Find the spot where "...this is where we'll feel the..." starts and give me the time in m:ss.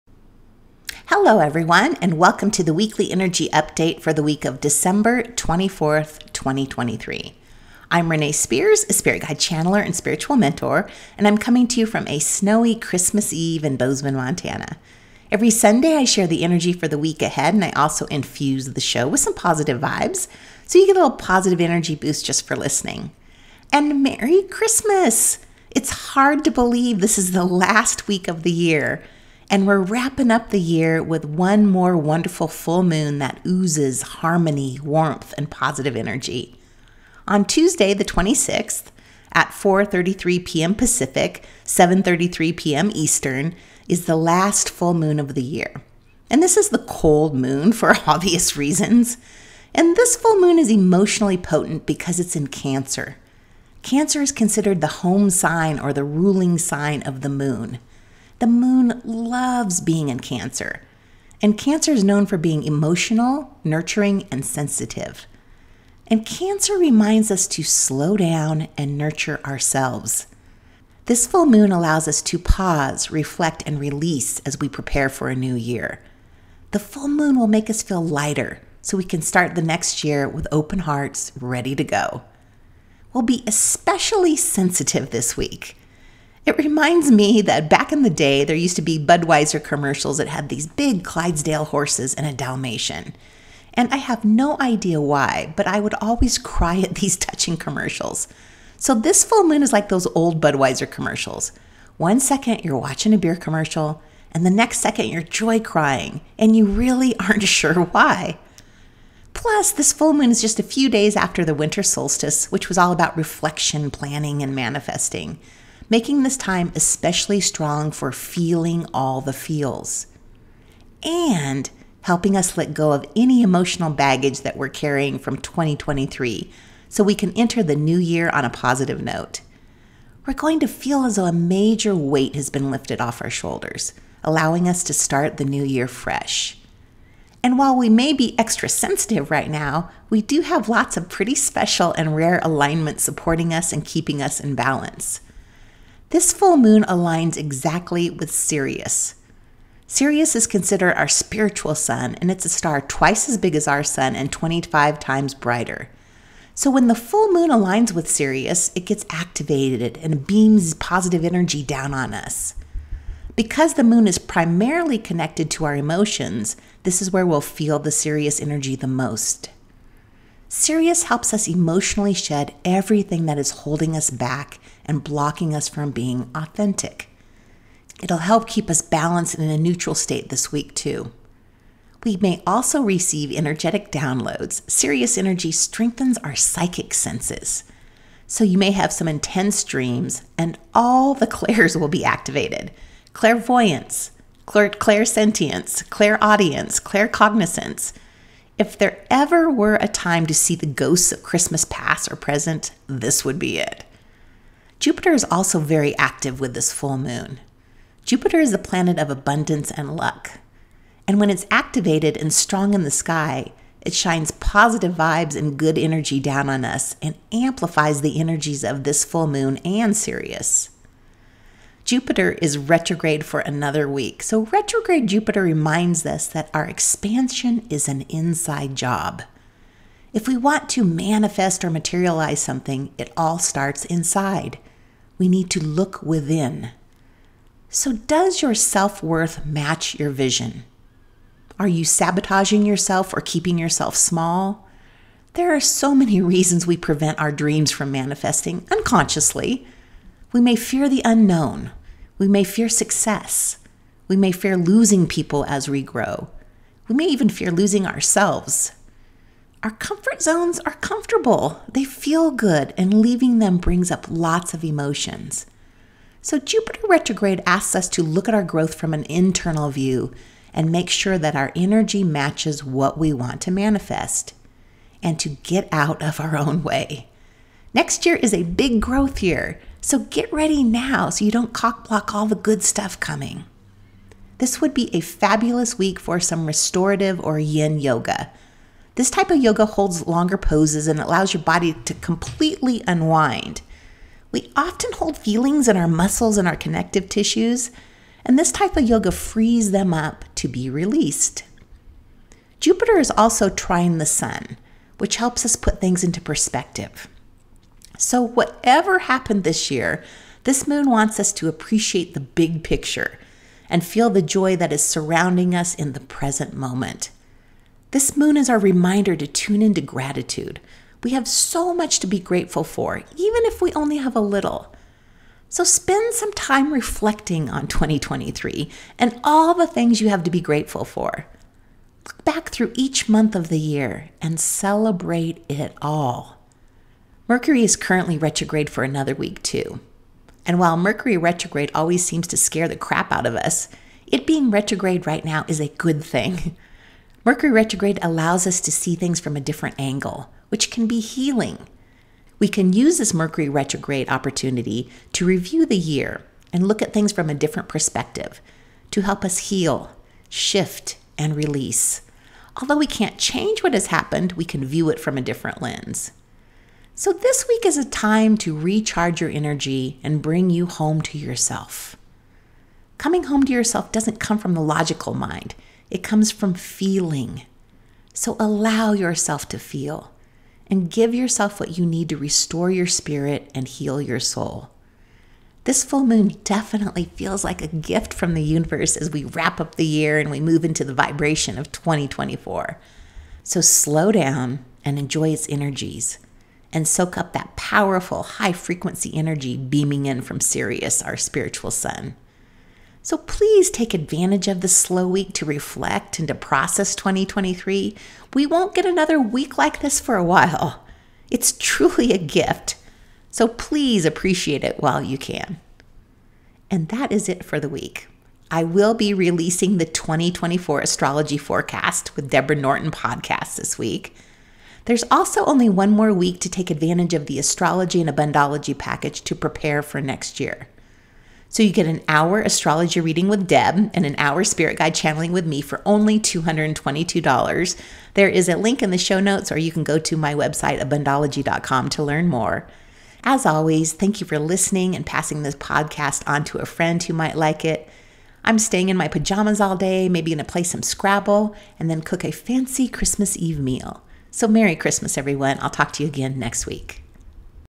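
2:46.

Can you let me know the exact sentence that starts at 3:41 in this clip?
Jupiter is retrograde for another week.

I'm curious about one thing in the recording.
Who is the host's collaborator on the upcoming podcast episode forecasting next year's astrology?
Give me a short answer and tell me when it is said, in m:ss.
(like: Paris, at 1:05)
Deborah Norton, at 7:02.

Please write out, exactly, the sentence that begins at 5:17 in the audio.
This moon is our reminder to tune into gratitude.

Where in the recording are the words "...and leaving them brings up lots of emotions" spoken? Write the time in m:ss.
4:22.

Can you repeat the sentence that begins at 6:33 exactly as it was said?
So slow down and enjoy its energies and soak up that powerful high frequency energy beaming in from Sirius, our spiritual sun.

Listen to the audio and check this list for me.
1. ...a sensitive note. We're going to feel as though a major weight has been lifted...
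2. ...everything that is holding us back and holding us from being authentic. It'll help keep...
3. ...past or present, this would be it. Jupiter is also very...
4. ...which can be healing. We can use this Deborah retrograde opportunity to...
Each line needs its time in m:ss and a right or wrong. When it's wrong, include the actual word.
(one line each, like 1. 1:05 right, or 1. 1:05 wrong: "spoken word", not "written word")
1. 2:08 wrong: "positive", not "sensitive"
2. 2:52 wrong: "blocking", not "holding"
3. 3:21 right
4. 5:50 wrong: "Mercury", not "Deborah".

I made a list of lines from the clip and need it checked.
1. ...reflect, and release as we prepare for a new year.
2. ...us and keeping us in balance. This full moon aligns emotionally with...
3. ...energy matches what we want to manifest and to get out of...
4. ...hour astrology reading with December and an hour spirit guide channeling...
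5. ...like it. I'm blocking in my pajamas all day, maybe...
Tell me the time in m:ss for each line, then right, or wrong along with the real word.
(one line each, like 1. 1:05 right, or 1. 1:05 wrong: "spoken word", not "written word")
1. 1:13 right
2. 2:23 wrong: "exactly", not "emotionally"
3. 4:31 right
4. 7:12 wrong: "Deb", not "December"
5. 7:27 wrong: "staying", not "blocking".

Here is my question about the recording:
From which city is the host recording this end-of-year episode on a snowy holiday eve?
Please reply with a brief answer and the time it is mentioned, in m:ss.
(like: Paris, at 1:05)
Bozeman, Montana, at 0:13.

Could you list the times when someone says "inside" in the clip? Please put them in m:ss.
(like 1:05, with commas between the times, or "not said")
3:48, 3:53.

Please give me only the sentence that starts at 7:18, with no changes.
There is a link in the show notes, or you can go to my website, abundology.com, to learn more.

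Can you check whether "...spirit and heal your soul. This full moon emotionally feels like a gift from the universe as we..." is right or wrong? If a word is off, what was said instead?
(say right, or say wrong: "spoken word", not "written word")
wrong: "definitely", not "emotionally".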